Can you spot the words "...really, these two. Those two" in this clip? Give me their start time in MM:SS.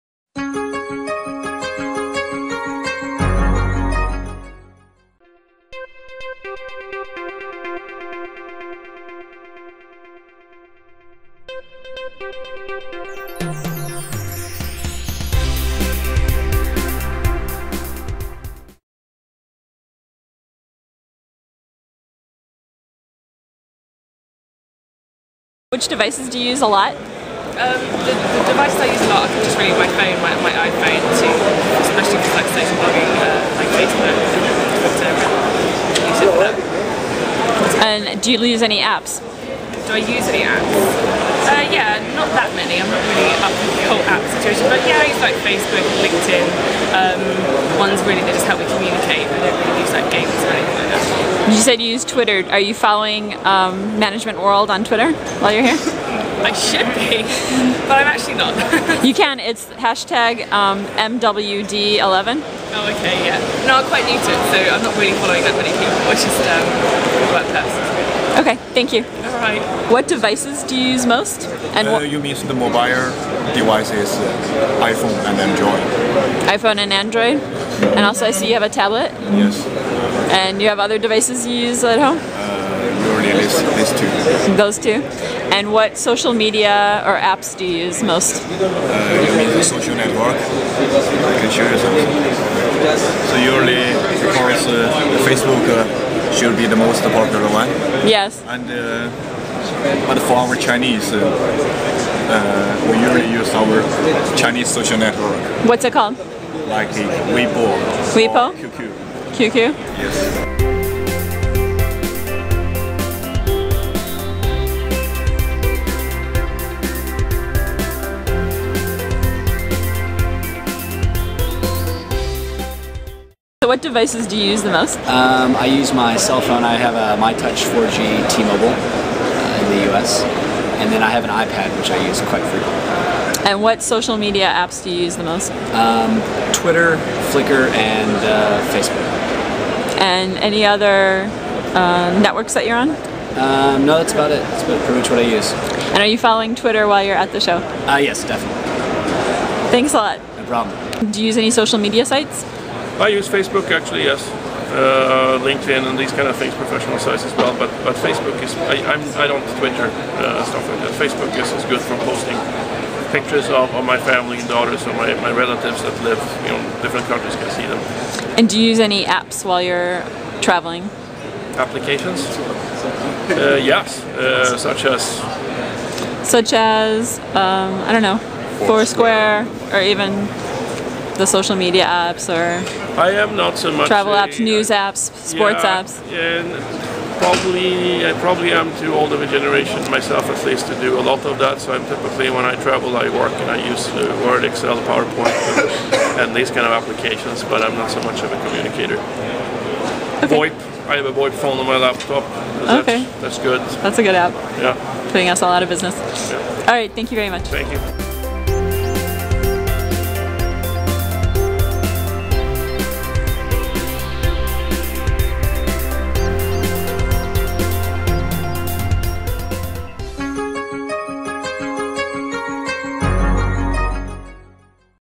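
01:23.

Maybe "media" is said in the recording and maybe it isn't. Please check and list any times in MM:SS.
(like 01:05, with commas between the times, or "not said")
01:26, 02:14, 02:31, 03:01.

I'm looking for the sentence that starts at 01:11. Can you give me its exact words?
And uh, you mean the mobile devices, uh, iPhone and Android.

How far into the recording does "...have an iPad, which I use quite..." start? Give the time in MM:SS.
02:11.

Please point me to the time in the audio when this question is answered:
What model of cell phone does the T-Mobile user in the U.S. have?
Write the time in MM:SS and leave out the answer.
02:07.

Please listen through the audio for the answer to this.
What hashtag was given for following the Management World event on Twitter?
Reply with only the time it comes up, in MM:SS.
01:00.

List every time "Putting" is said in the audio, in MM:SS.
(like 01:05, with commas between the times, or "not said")
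03:25.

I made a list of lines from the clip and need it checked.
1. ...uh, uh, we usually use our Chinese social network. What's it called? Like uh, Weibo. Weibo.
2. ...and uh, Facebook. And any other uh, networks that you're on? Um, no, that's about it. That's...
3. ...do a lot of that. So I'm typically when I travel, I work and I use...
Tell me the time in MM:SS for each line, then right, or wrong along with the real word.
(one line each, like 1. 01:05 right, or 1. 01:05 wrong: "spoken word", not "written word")
1. 01:41 right
2. 02:17 right
3. 03:10 right.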